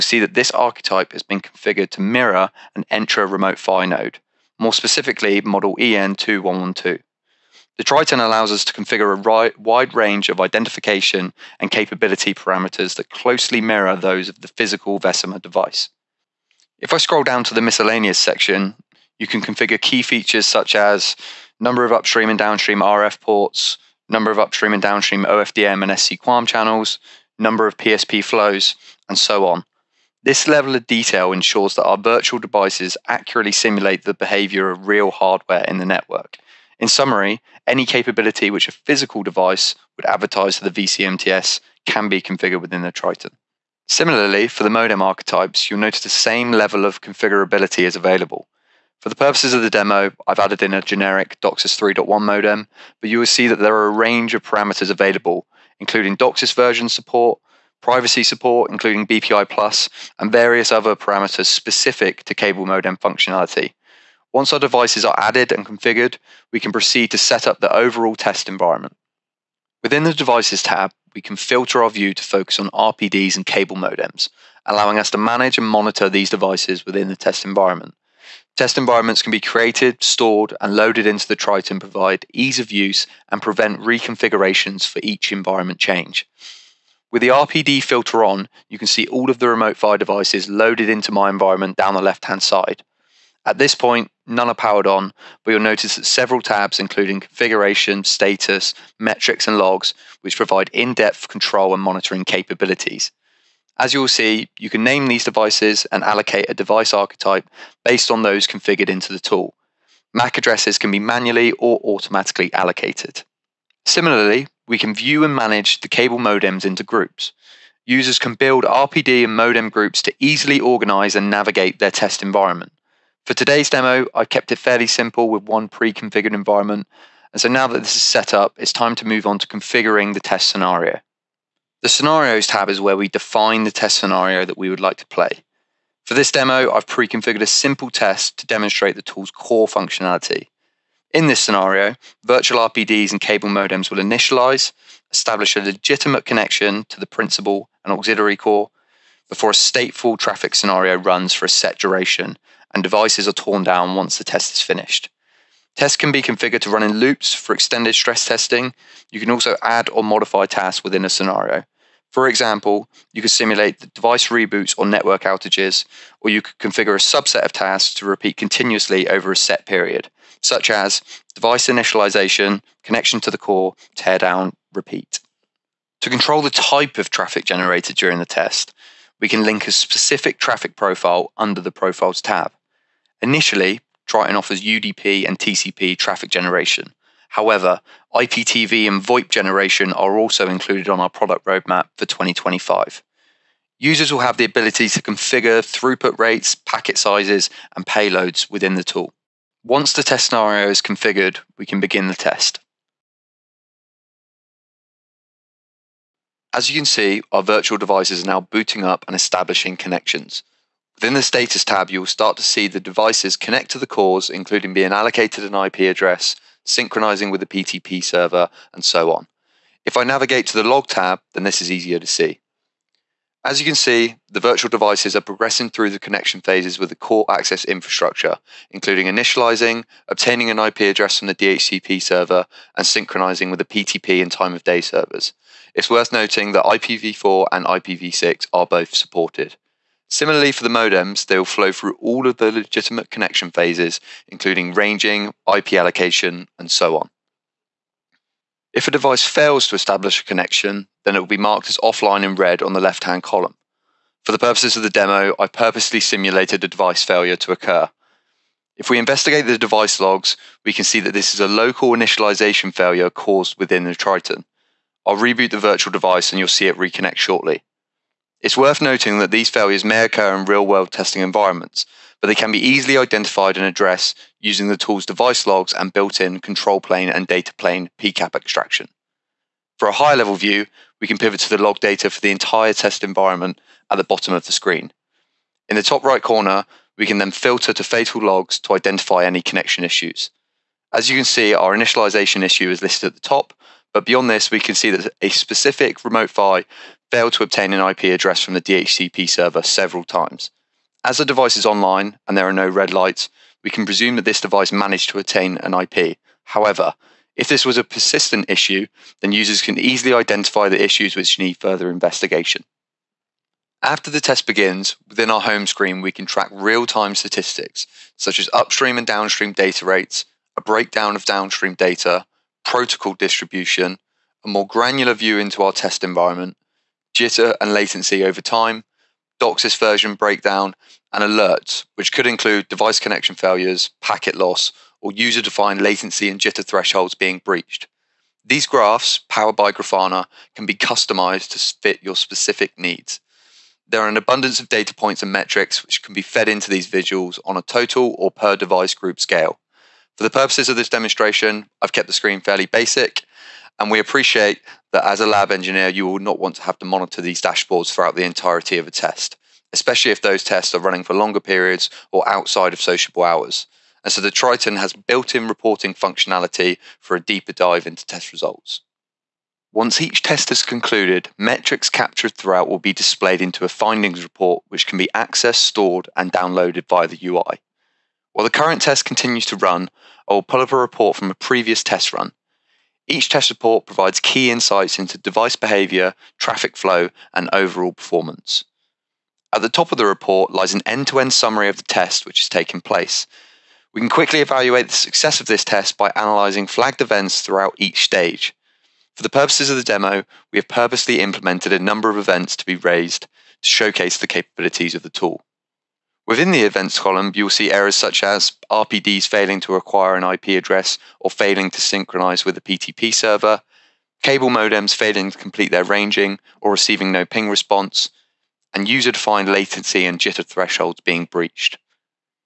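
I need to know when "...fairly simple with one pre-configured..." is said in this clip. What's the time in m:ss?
2:04.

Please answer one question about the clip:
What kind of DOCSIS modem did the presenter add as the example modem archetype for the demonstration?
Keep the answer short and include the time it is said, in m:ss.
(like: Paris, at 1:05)
Generic DOCSIS 3.1 modem, at 0:50.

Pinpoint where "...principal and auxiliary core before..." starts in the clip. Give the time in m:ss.
2:27.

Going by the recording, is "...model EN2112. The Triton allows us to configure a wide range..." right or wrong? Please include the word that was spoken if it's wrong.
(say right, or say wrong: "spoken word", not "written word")
right.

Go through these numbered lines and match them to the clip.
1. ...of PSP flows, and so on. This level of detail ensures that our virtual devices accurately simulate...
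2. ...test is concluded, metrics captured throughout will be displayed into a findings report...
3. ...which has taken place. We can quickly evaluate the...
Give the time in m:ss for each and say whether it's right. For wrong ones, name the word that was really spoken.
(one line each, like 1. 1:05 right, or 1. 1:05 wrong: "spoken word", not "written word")
1. 0:27 right
2. 6:10 right
3. 6:32 right.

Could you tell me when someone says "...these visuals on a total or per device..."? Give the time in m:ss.
5:46.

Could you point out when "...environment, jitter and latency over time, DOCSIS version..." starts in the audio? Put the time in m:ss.
5:26.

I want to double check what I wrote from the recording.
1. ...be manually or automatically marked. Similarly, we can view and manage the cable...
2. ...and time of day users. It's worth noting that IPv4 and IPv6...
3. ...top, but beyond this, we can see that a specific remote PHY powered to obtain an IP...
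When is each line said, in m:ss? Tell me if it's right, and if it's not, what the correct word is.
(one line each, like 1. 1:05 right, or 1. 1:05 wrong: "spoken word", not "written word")
1. 1:50 wrong: "allocated", not "marked"
2. 3:54 wrong: "servers", not "users"
3. 4:53 wrong: "failed", not "powered".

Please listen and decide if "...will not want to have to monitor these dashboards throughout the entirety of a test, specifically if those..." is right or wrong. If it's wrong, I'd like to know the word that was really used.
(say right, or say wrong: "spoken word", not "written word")
wrong: "especially", not "specifically".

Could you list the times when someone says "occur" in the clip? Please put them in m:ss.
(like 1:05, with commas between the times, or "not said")
4:17, 4:30.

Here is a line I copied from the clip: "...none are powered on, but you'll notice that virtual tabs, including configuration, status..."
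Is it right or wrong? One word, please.
wrong.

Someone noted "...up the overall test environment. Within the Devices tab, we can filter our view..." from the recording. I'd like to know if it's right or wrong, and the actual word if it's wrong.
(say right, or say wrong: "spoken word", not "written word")
right.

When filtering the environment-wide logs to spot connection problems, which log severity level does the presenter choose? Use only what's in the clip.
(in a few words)
Fatal.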